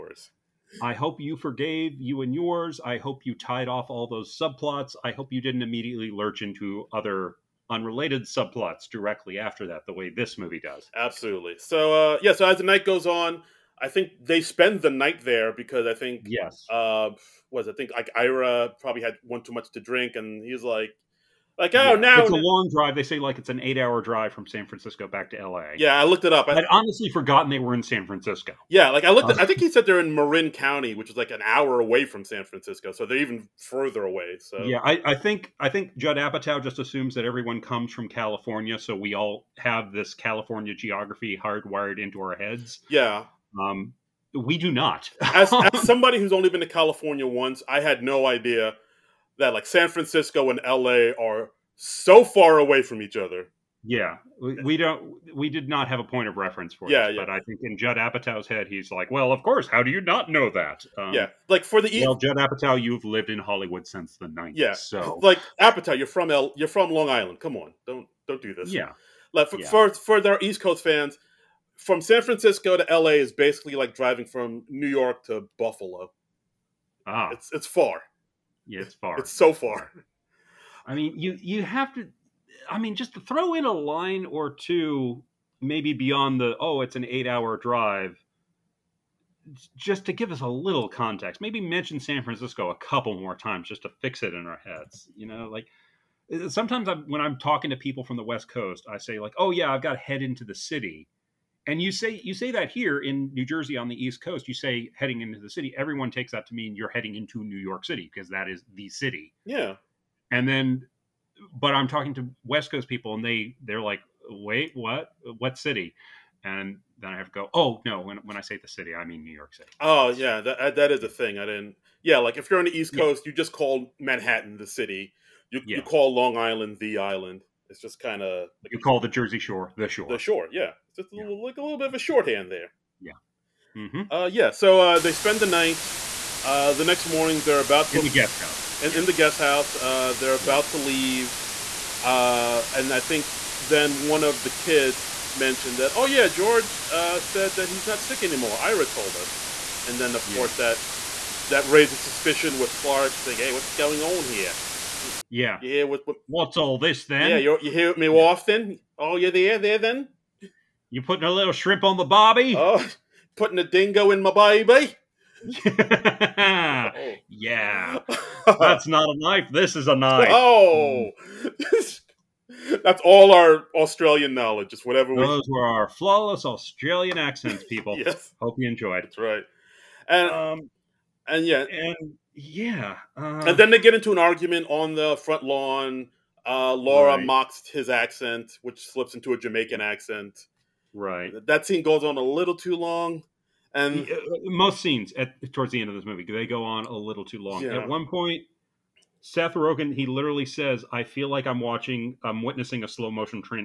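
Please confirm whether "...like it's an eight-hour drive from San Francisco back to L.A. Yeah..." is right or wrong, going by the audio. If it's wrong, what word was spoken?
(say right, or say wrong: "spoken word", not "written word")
right.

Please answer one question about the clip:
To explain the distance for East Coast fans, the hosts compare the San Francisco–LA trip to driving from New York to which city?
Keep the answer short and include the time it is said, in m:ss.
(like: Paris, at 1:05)
Buffalo, at 1:15.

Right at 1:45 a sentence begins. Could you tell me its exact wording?
Everyone takes that to mean you're heading into New York City because that is the city.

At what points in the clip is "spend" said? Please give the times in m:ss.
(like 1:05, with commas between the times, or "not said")
0:14, 2:15.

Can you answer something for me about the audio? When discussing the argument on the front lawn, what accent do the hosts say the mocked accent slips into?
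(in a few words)
Jamaican.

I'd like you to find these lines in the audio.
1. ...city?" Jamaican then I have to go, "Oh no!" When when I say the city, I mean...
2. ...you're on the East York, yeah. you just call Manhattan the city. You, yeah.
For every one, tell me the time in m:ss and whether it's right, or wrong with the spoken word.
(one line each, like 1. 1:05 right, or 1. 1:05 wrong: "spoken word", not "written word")
1. 1:55 wrong: "And", not "Jamaican"
2. 2:02 wrong: "Coast", not "York".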